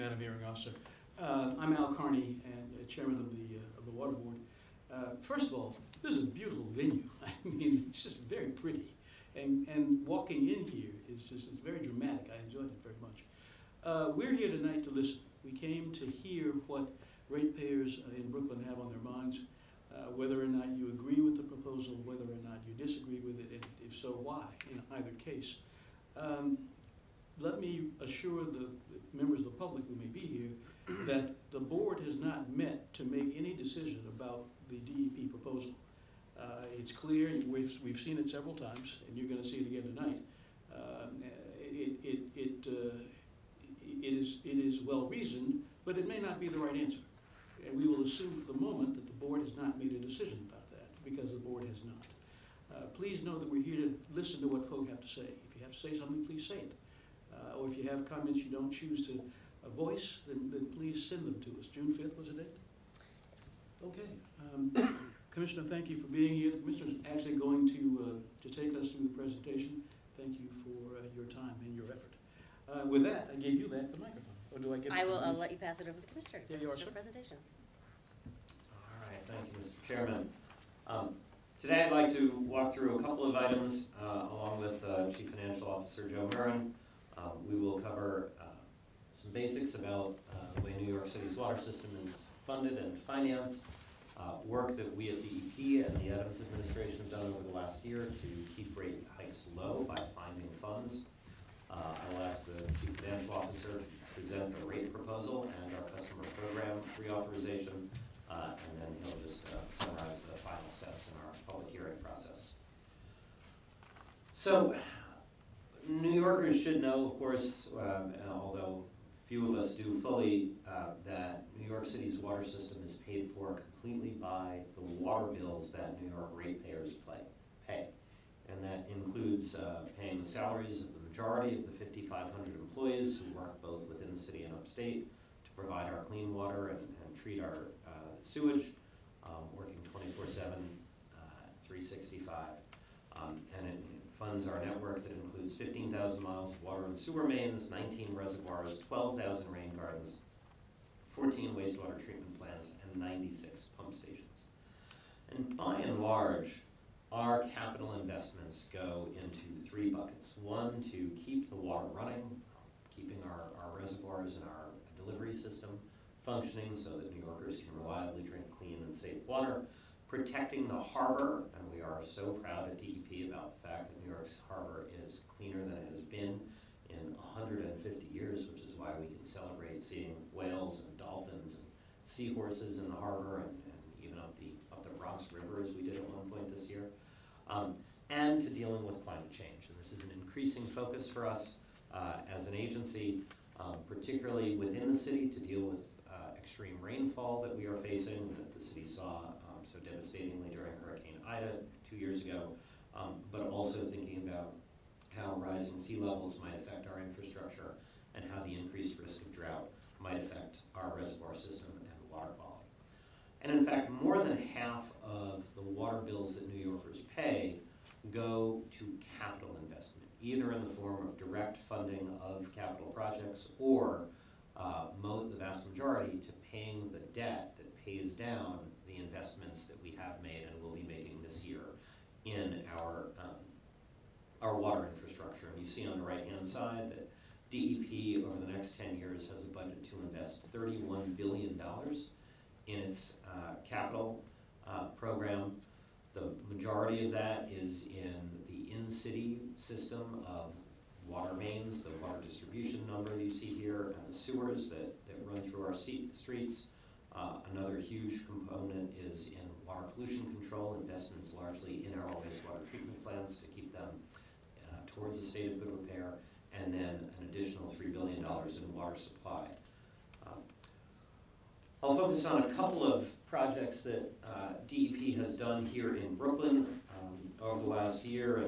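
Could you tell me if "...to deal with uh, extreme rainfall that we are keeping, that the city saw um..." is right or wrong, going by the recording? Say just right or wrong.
wrong.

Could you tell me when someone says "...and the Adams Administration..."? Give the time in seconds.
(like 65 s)
95 s.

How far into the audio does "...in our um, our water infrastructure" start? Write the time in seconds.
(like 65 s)
232 s.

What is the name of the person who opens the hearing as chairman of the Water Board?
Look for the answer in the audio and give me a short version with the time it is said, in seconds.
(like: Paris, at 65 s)
Al Carney, at 1 s.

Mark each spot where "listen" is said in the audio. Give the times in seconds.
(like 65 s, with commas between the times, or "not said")
14 s, 54 s.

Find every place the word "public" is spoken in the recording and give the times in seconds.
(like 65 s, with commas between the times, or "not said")
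29 s, 111 s.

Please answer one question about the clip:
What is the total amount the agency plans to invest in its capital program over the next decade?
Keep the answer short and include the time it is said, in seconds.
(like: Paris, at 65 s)
$31 billion, at 240 s.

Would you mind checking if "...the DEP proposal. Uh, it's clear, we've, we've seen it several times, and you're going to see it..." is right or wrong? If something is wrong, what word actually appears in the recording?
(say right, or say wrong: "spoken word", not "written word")
right.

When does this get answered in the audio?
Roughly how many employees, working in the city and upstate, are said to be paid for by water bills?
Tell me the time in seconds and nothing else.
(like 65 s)
131 s.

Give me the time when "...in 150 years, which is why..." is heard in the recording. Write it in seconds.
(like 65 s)
176 s.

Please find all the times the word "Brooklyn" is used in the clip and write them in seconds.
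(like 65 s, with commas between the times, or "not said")
18 s, 276 s.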